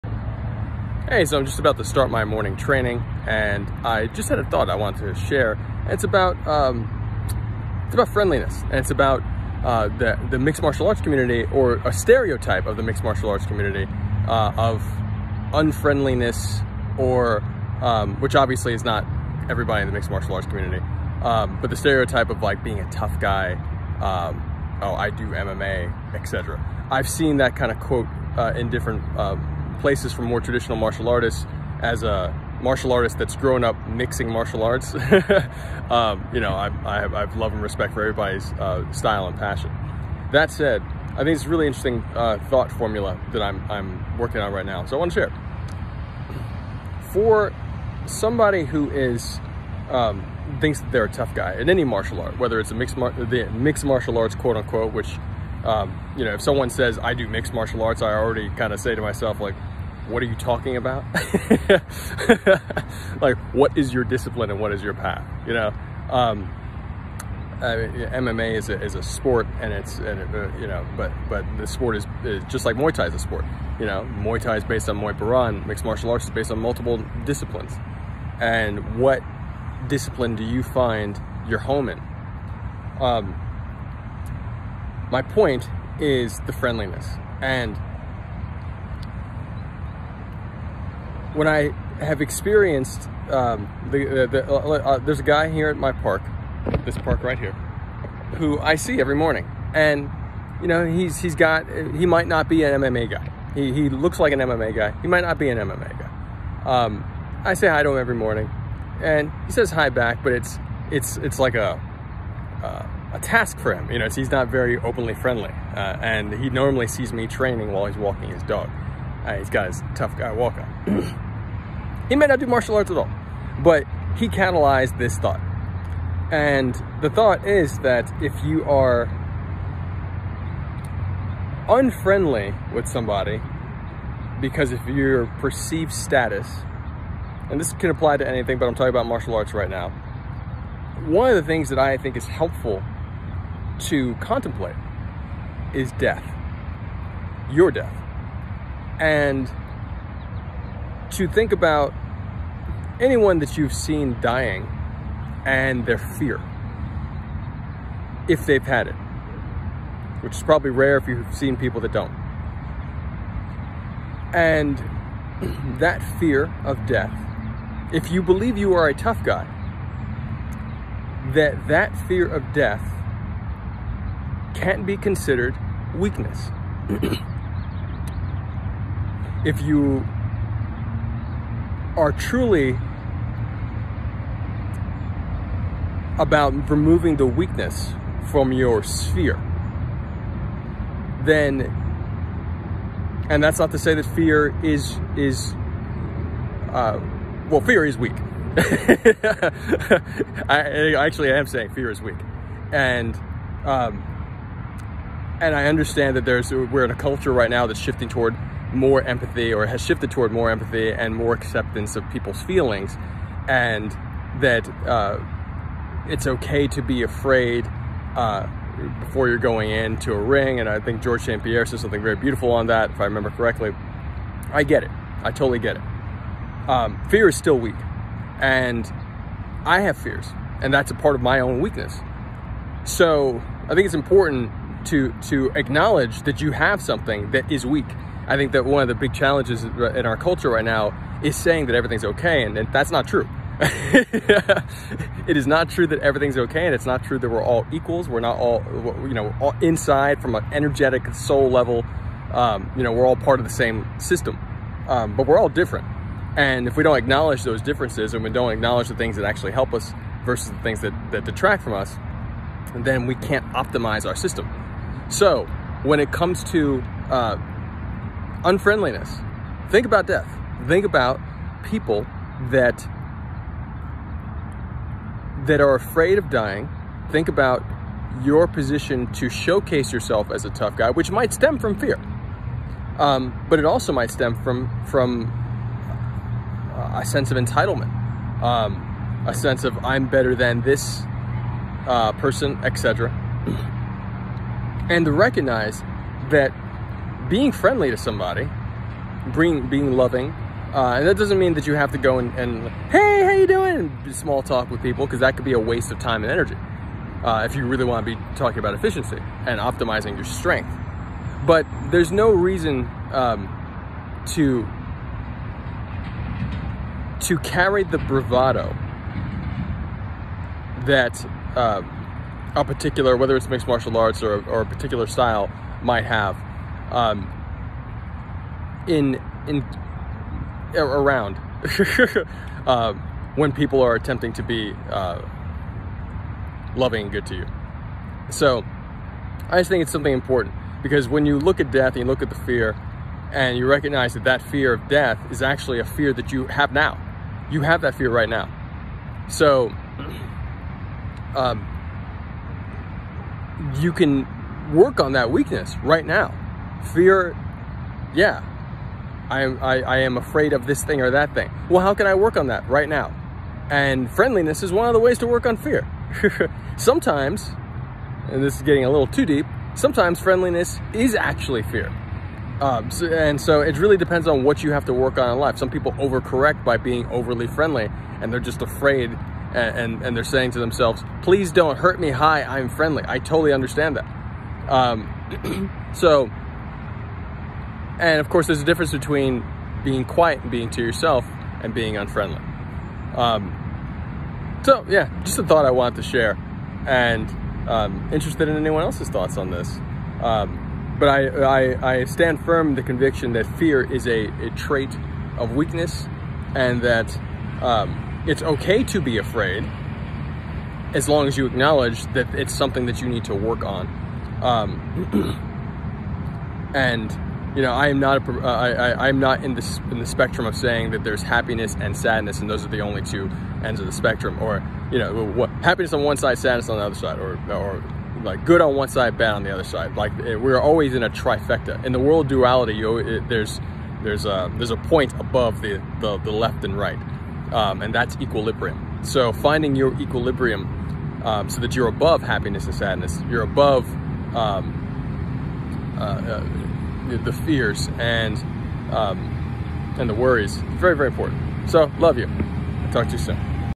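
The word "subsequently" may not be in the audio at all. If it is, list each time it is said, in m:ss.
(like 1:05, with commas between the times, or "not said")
not said.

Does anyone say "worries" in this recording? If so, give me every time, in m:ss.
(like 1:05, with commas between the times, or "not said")
7:30.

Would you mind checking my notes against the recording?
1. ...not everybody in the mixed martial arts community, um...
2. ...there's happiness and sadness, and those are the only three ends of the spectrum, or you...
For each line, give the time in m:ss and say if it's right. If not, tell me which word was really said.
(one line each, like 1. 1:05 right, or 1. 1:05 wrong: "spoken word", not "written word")
1. 0:18 right
2. 7:01 wrong: "two", not "three".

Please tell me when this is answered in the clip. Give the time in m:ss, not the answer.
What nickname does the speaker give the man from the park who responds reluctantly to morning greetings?
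1:59.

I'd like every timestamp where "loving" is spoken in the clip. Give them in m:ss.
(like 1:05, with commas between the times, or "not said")
4:59, 5:36.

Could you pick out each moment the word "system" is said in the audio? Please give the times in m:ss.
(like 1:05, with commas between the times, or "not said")
4:13, 4:24.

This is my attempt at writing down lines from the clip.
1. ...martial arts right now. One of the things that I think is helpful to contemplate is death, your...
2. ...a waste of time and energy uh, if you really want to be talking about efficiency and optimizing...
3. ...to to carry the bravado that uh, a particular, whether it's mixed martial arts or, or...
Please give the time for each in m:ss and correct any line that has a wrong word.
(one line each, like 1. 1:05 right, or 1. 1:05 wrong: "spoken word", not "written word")
1. 2:19 right
2. 5:05 right
3. 5:14 right.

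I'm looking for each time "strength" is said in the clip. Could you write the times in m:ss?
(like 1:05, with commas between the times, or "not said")
5:10.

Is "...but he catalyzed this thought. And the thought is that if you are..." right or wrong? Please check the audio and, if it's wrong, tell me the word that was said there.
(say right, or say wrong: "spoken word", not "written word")
right.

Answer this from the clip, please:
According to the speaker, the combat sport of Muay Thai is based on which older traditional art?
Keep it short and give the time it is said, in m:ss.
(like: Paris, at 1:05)
Muay Paran, at 1:14.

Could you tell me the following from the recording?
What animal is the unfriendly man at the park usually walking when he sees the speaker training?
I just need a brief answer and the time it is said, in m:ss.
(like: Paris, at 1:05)
His dog, at 1:58.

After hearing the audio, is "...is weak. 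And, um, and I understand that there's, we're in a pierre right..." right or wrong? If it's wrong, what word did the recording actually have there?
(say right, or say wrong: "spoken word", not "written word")
wrong: "culture", not "pierre".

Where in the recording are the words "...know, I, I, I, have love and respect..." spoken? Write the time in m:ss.
0:36.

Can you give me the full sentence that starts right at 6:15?
Some people overcorrect by being overly friendly and they're just afraid and, and, and they're saying to themselves, please don't hurt me.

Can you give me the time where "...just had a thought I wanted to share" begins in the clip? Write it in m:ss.
0:04.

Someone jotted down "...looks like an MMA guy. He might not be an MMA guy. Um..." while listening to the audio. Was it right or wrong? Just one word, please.
right.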